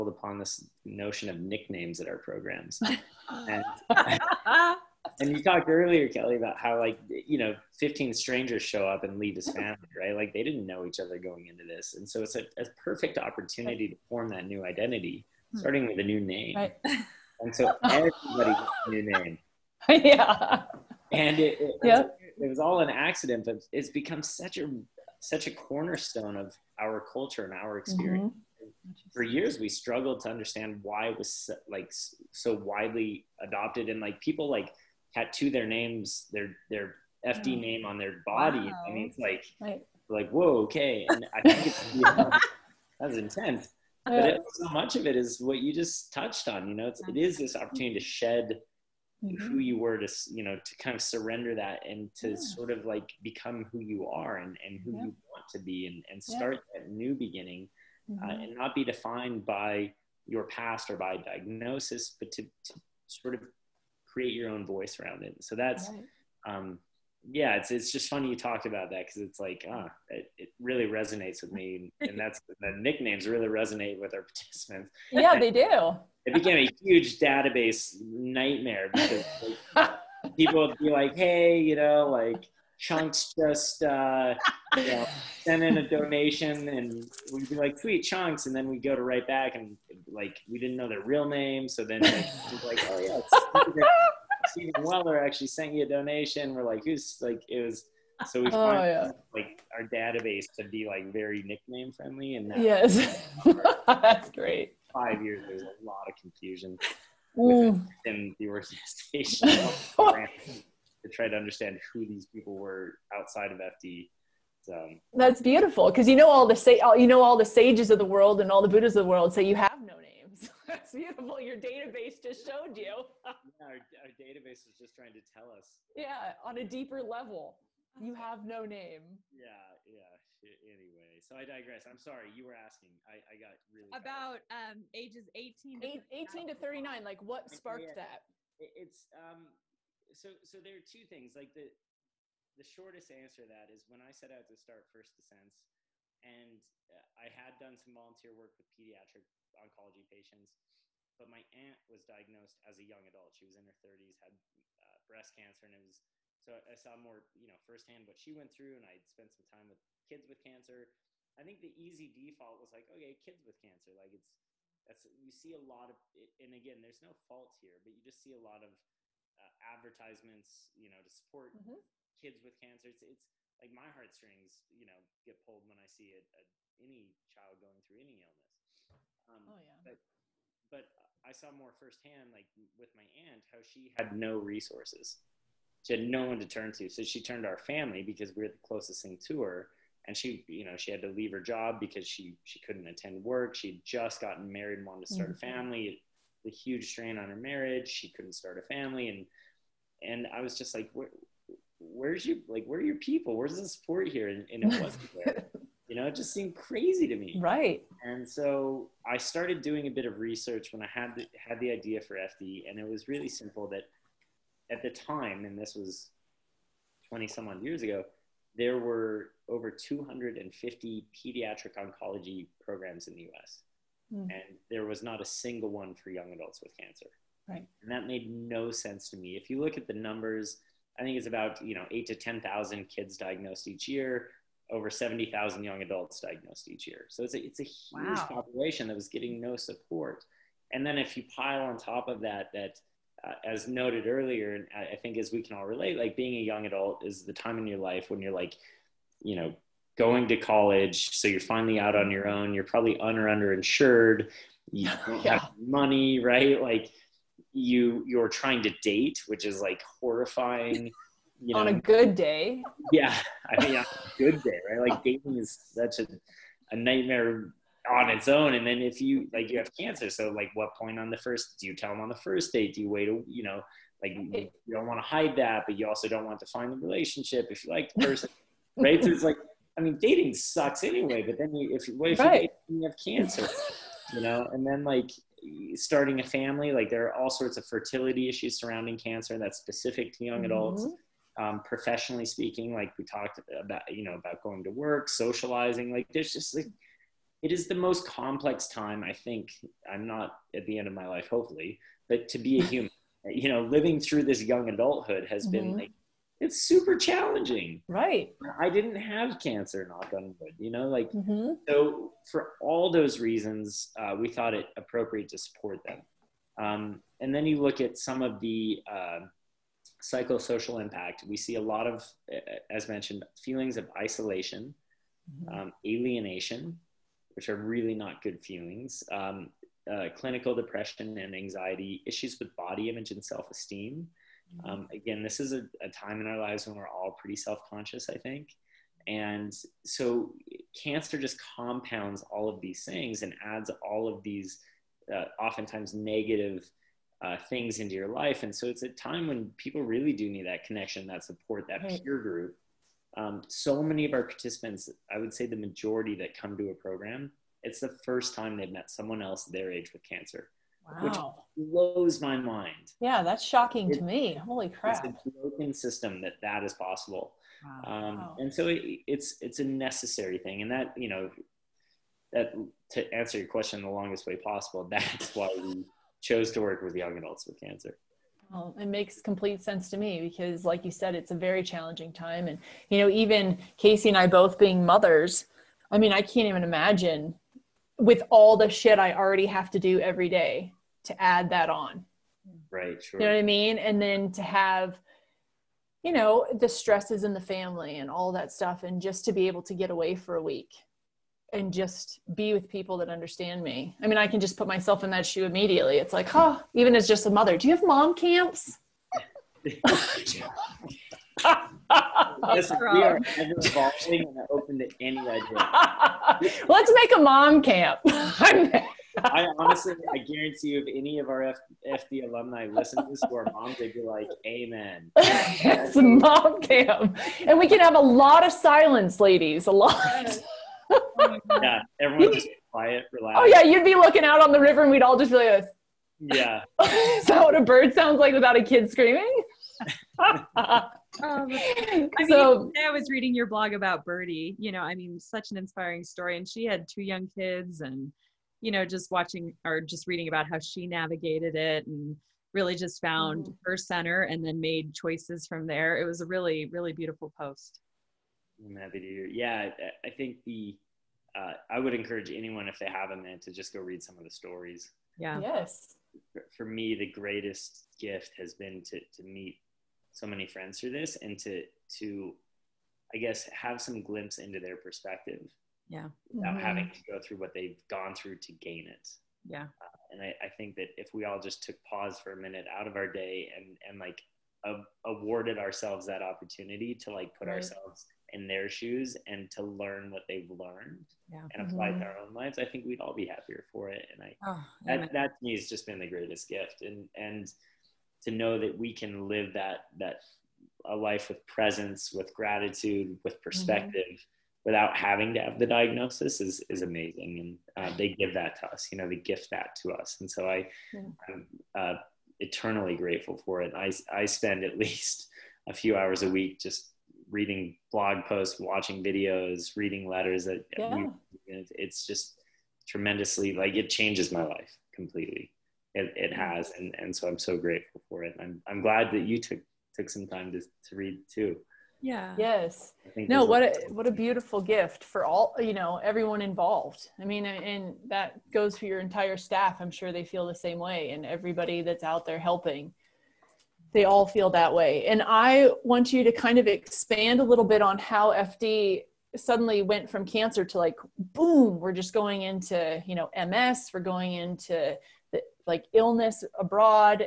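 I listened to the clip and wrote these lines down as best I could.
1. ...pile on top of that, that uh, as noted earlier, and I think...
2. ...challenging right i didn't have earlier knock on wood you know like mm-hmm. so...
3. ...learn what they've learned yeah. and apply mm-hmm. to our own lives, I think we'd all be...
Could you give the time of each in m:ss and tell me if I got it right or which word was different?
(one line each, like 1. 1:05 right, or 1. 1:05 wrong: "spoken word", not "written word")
1. 4:01 right
2. 5:06 wrong: "cancer", not "earlier"
3. 8:09 right.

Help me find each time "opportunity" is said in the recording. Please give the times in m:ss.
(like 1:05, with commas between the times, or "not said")
0:13, 0:47, 8:06.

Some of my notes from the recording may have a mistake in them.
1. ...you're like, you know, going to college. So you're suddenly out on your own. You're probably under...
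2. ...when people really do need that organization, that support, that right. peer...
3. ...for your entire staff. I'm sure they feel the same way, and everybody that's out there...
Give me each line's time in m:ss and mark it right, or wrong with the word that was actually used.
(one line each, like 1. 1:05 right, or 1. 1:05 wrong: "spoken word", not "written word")
1. 4:08 wrong: "finally", not "suddenly"
2. 5:49 wrong: "connection", not "organization"
3. 8:58 right.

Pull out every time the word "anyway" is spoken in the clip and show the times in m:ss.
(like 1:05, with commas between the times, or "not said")
2:10, 4:40.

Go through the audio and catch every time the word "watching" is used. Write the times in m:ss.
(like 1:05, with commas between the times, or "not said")
7:29, 8:38.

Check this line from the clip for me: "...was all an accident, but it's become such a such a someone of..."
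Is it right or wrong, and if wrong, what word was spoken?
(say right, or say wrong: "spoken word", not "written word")
wrong: "cornerstone", not "someone".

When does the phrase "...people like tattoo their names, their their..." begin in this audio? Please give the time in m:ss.
0:34.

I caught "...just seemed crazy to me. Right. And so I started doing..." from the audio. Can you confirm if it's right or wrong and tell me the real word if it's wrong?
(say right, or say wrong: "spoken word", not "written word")
right.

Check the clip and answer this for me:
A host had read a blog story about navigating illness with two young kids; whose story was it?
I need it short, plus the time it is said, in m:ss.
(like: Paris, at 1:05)
Birdie, at 7:24.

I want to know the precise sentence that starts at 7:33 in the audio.
her center and then made choices from there.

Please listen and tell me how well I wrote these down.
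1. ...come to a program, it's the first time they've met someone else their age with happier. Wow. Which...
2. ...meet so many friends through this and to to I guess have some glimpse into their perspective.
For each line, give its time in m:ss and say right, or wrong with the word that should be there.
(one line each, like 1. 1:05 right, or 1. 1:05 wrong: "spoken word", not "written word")
1. 5:56 wrong: "cancer", not "happier"
2. 7:49 right.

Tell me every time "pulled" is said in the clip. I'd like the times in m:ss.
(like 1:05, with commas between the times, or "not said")
2:55.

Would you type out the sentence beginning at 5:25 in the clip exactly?
um, alienation which are really not good feelings.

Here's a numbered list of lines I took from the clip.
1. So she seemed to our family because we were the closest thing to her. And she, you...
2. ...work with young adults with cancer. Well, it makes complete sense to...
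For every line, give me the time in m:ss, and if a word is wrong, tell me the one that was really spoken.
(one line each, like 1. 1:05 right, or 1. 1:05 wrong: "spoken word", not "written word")
1. 3:06 wrong: "turned", not "seemed"
2. 6:16 right.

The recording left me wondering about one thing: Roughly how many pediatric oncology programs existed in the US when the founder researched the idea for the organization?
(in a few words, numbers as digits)
250.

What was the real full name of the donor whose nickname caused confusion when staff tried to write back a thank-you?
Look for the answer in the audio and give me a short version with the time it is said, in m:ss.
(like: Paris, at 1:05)
Stephen Weller, at 1:34.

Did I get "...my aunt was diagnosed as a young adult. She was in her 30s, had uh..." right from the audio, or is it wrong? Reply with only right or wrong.
right.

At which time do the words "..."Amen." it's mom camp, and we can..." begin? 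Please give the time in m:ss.
7:04.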